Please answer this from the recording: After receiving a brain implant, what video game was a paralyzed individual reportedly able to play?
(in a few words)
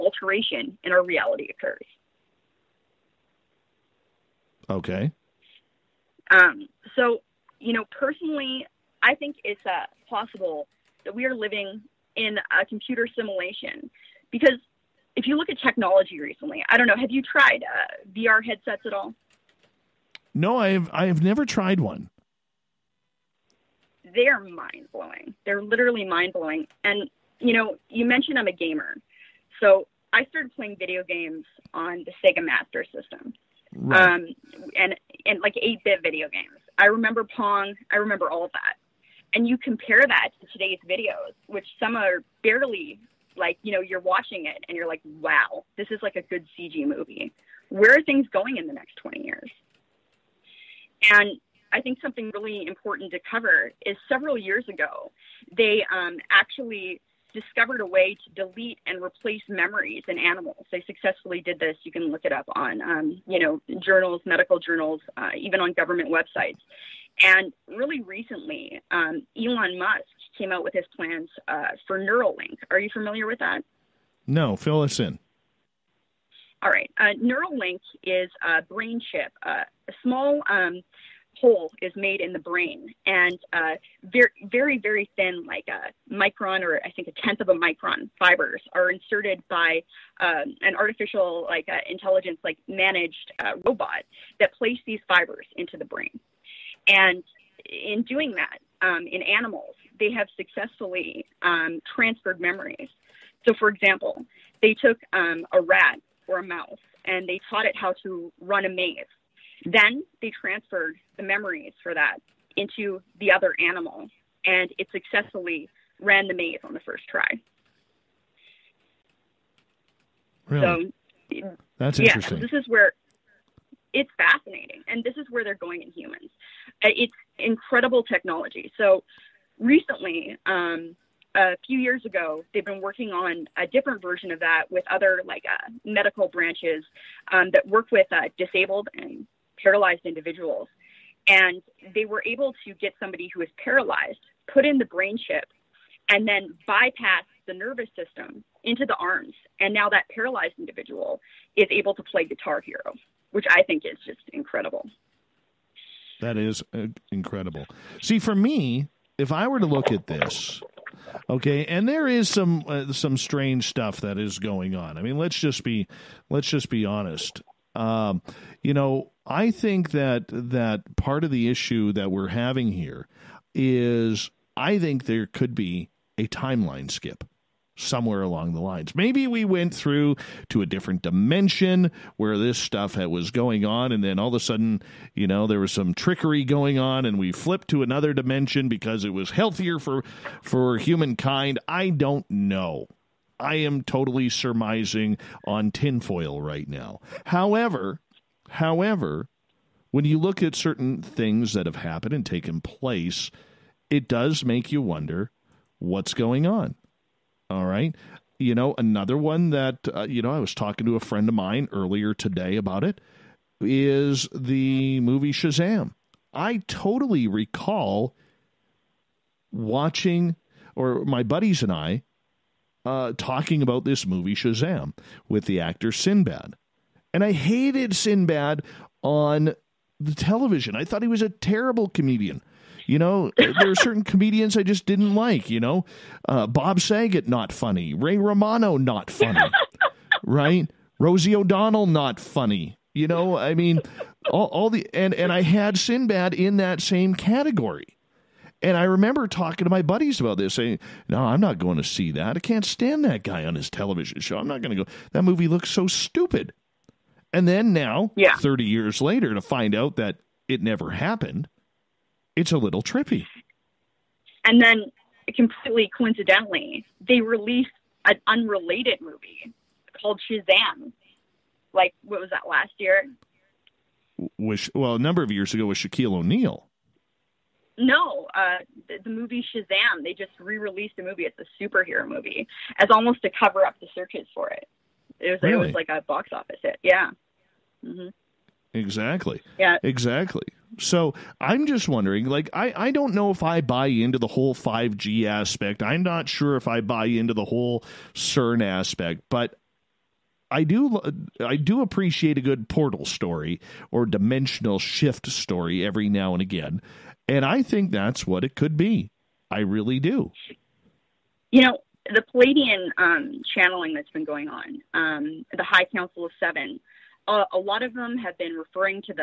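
Guitar Hero.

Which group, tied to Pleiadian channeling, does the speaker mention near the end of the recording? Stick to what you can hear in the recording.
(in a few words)
High Council of Seven.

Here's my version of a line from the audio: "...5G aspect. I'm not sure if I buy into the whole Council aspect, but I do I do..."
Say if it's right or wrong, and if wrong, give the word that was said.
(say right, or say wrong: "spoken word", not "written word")
wrong: "CERN", not "Council".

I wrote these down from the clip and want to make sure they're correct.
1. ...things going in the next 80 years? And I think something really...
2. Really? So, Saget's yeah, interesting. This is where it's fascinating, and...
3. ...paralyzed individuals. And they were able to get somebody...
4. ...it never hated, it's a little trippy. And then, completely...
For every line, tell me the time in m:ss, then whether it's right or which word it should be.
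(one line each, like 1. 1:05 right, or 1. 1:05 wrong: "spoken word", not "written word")
1. 0:48 wrong: "20", not "80"
2. 2:00 wrong: "That", not "Saget"
3. 2:19 right
4. 4:20 wrong: "happened", not "hated".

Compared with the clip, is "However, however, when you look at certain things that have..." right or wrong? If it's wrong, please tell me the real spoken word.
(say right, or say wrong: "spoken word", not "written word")
right.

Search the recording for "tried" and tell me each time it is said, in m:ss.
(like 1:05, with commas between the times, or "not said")
0:17, 0:21.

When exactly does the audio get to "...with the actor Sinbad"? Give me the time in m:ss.
3:45.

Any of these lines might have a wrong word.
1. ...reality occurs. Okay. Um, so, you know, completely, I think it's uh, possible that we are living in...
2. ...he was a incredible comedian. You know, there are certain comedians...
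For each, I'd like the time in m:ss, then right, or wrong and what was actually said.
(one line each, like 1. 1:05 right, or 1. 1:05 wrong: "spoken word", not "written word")
1. 0:01 wrong: "personally", not "completely"
2. 3:51 wrong: "terrible", not "incredible".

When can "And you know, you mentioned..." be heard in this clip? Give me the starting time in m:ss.
0:26.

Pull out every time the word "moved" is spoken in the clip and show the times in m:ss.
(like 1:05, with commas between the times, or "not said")
not said.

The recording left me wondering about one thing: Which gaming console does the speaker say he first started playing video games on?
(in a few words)
Sega Master System.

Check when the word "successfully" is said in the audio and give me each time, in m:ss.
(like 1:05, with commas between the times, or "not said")
1:00, 1:40, 1:54.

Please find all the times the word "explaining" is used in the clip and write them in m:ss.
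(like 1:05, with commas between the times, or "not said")
not said.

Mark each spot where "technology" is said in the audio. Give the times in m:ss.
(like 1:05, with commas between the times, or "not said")
0:15, 2:08.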